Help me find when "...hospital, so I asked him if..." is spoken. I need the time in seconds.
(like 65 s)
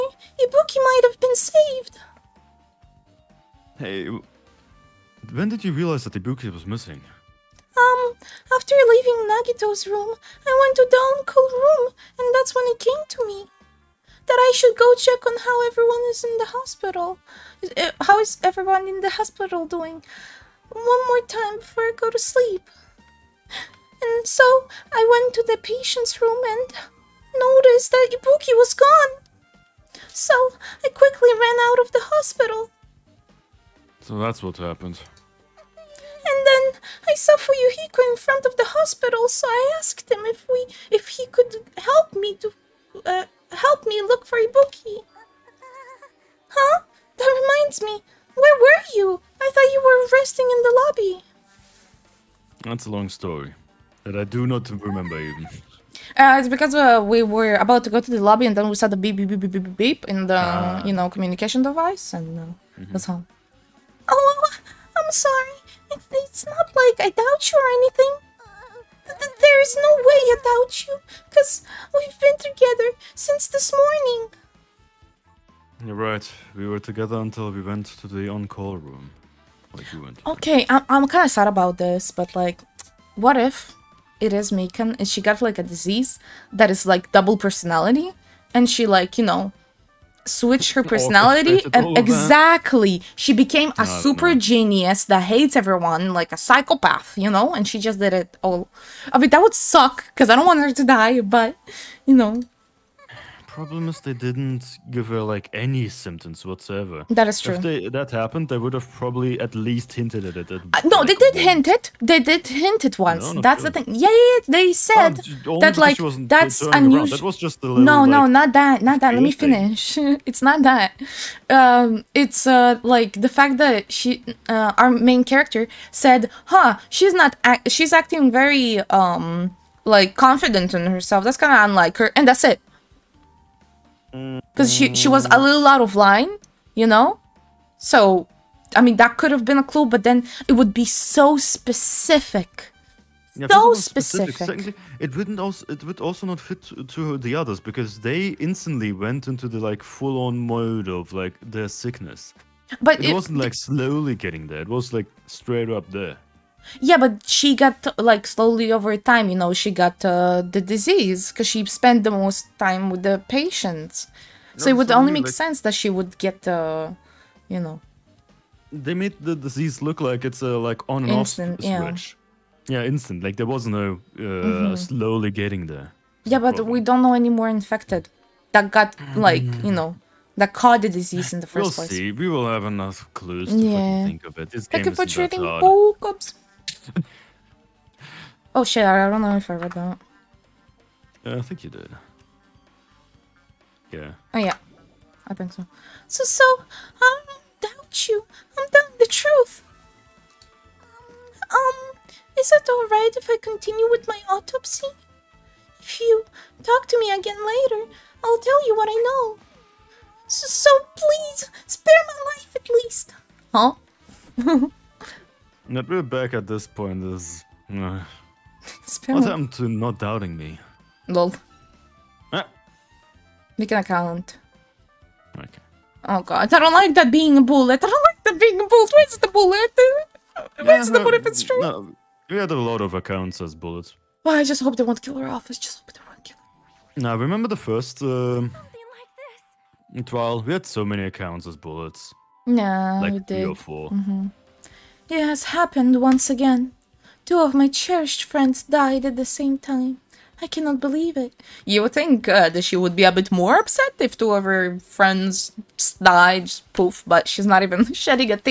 38 s.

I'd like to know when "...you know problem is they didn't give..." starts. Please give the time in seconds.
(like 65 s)
102 s.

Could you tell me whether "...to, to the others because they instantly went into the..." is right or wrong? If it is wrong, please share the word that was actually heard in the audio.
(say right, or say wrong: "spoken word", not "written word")
right.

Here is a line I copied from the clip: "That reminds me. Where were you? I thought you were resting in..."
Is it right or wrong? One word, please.
right.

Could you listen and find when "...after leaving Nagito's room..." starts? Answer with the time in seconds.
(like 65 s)
8 s.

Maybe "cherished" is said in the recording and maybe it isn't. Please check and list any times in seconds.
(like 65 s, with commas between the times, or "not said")
247 s.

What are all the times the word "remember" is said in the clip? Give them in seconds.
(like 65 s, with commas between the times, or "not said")
54 s, 237 s.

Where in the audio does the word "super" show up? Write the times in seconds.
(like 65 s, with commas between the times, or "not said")
93 s.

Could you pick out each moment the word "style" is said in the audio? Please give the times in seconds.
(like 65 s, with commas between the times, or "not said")
not said.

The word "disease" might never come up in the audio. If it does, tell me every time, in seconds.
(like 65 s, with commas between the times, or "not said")
85 s, 160 s, 169 s, 181 s.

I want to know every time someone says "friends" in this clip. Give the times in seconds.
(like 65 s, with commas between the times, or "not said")
248 s, 254 s.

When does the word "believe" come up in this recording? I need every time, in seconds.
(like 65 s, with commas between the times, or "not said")
250 s.